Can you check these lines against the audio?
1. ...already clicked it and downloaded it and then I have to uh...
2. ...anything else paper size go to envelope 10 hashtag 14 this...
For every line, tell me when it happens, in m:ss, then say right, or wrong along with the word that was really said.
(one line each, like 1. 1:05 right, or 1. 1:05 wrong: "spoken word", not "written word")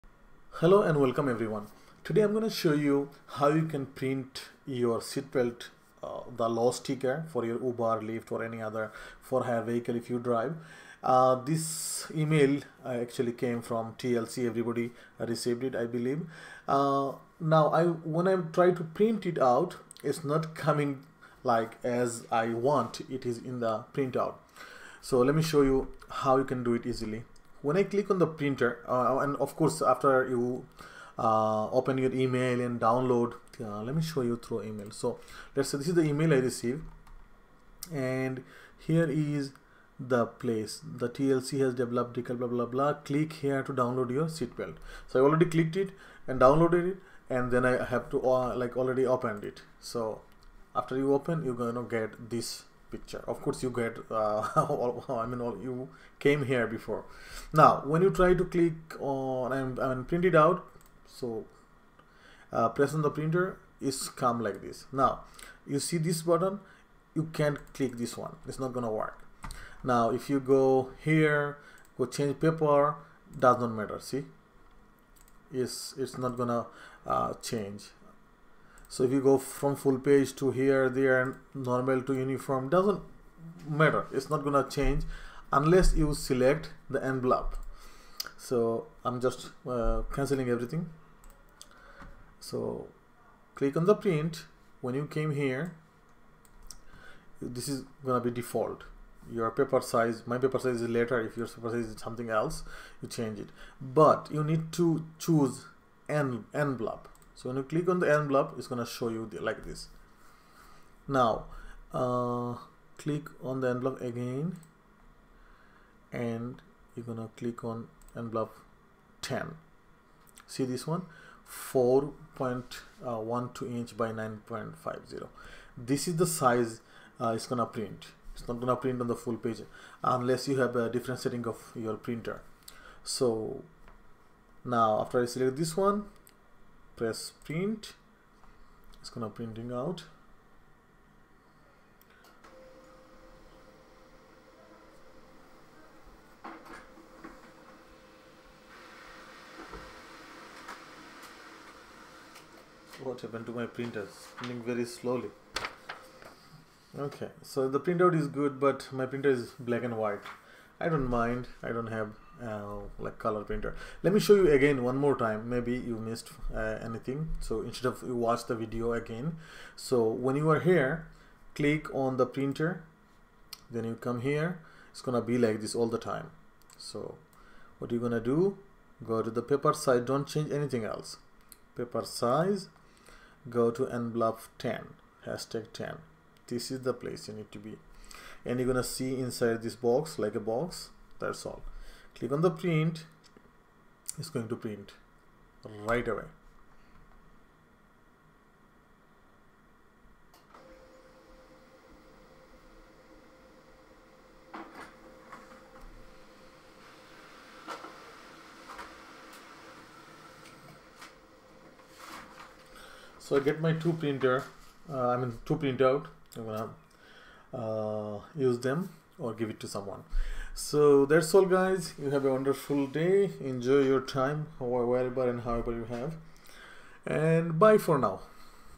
1. 0:45 right
2. 3:00 wrong: "10", not "14".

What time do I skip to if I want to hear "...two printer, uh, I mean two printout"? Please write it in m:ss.
3:33.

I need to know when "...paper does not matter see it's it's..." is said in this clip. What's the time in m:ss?
1:12.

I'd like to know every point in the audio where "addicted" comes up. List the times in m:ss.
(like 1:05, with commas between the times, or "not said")
not said.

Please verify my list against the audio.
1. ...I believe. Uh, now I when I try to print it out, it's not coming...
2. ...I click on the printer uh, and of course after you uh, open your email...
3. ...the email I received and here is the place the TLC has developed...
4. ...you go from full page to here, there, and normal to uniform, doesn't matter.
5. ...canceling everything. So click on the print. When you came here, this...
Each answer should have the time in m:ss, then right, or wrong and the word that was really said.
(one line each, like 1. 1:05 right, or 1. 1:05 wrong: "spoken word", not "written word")
1. 0:15 right
2. 0:27 right
3. 0:35 right
4. 1:19 right
5. 1:30 right.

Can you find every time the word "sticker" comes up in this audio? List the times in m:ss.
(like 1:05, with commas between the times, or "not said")
0:06.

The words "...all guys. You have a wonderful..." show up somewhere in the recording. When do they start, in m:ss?
3:41.